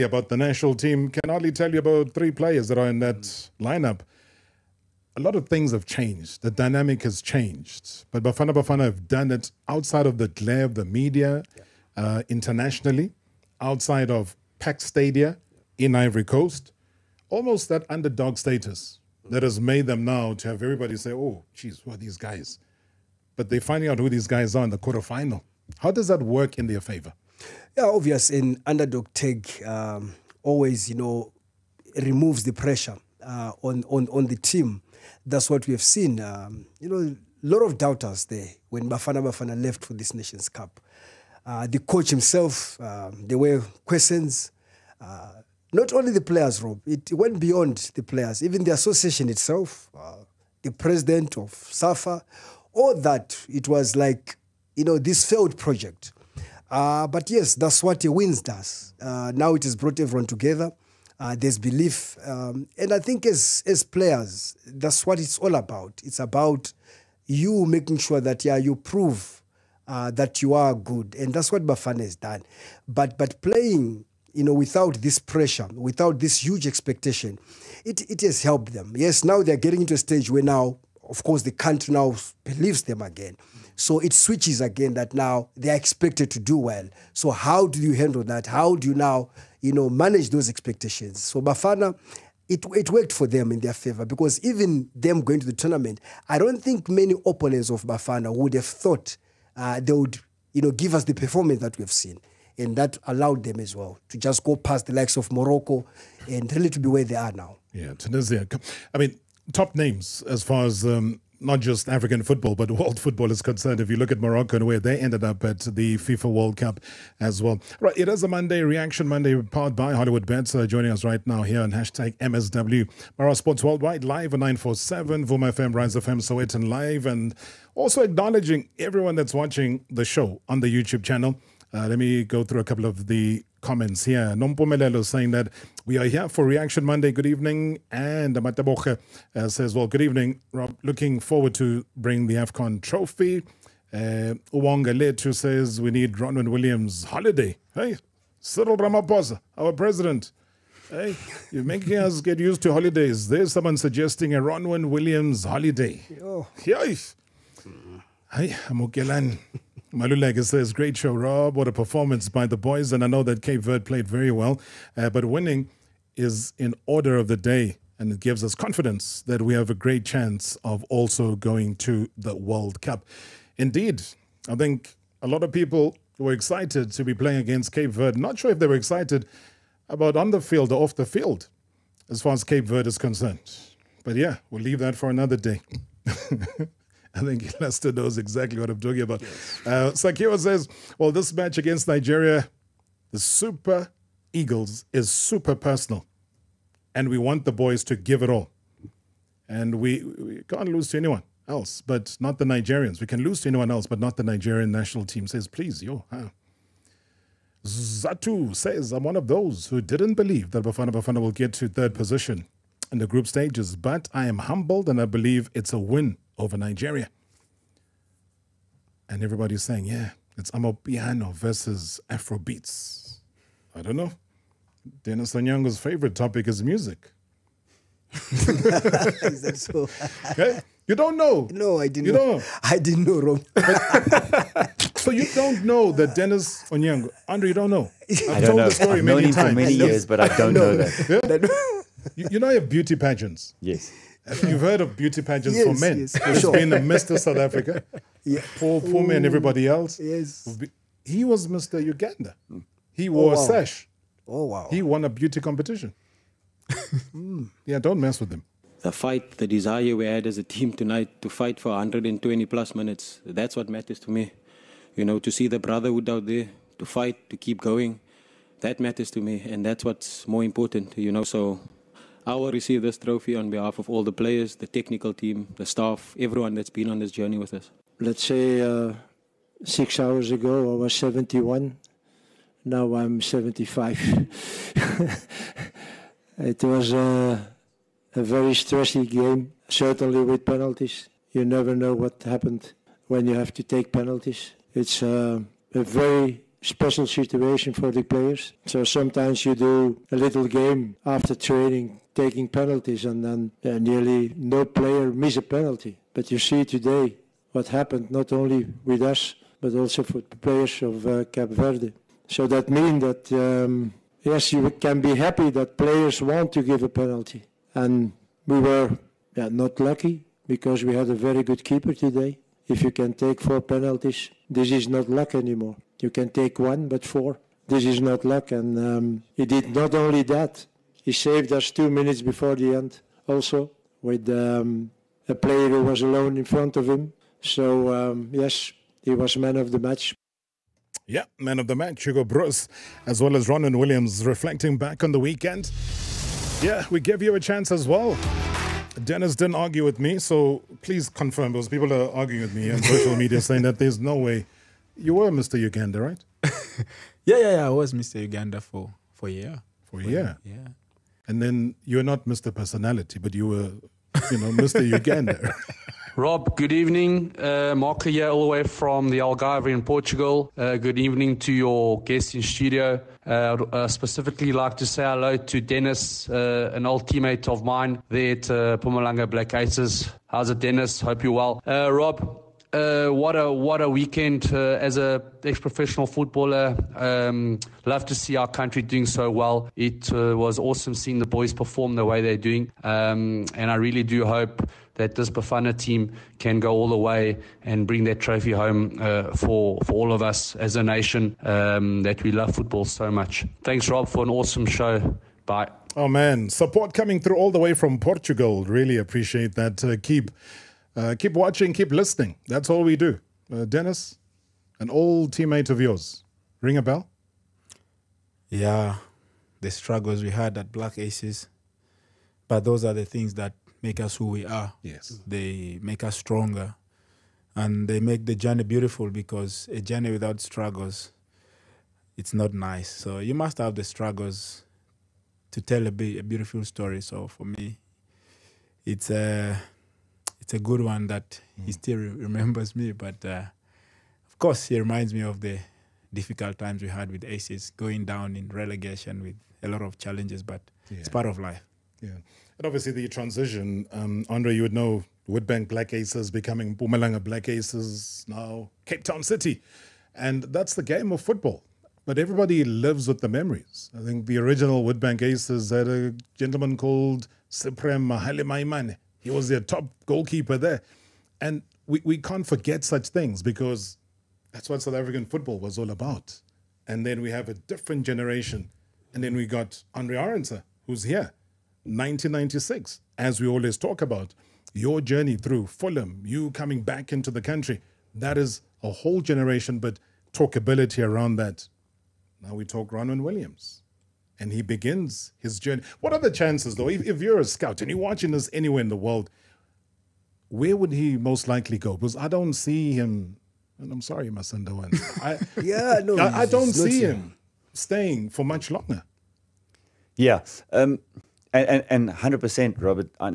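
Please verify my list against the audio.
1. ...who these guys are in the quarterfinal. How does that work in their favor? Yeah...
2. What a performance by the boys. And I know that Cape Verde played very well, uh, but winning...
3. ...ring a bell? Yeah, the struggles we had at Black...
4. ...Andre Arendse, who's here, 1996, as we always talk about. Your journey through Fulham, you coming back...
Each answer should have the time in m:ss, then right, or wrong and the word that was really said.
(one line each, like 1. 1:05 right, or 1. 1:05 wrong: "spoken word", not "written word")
1. 0:23 right
2. 2:41 right
3. 6:56 right
4. 7:59 right.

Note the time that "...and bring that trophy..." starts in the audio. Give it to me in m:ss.
6:37.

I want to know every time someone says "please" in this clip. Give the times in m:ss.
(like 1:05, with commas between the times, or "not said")
3:25, 5:50.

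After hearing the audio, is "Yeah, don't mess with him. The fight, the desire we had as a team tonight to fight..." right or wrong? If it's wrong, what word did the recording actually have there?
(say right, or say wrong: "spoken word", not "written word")
right.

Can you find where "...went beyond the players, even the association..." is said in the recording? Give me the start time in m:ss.
0:47.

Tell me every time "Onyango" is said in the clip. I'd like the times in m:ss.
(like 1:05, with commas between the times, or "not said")
3:45, 3:56.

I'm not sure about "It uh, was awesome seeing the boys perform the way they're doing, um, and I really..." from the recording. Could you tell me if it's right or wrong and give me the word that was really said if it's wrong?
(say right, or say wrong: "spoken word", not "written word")
right.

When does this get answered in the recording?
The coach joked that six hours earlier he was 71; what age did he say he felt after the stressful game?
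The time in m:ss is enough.
4:43.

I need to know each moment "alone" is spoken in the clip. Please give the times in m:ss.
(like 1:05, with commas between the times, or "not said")
5:36.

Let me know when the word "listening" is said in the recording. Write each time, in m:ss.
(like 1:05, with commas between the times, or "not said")
6:51.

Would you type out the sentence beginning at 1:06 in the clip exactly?
It's about you making sure that, yeah, you prove uh, that you are good.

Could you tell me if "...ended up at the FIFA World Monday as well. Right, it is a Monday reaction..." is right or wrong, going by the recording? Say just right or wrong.
wrong.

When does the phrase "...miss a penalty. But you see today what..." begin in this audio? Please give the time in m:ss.
5:05.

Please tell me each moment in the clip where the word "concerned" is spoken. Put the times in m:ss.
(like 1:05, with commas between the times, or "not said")
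1:53, 3:02.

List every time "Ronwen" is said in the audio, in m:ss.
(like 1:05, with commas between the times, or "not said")
2:26, 2:34, 5:43, 8:12.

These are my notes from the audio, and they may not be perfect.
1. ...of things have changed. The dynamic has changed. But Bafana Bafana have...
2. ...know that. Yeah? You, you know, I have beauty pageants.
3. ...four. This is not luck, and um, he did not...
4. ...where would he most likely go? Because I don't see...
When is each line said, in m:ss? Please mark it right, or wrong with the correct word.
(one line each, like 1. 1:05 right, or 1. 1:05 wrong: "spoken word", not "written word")
1. 0:05 right
2. 4:00 right
3. 5:27 right
4. 8:20 right.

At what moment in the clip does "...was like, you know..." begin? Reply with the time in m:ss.
0:53.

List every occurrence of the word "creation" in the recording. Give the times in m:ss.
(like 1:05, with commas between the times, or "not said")
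not said.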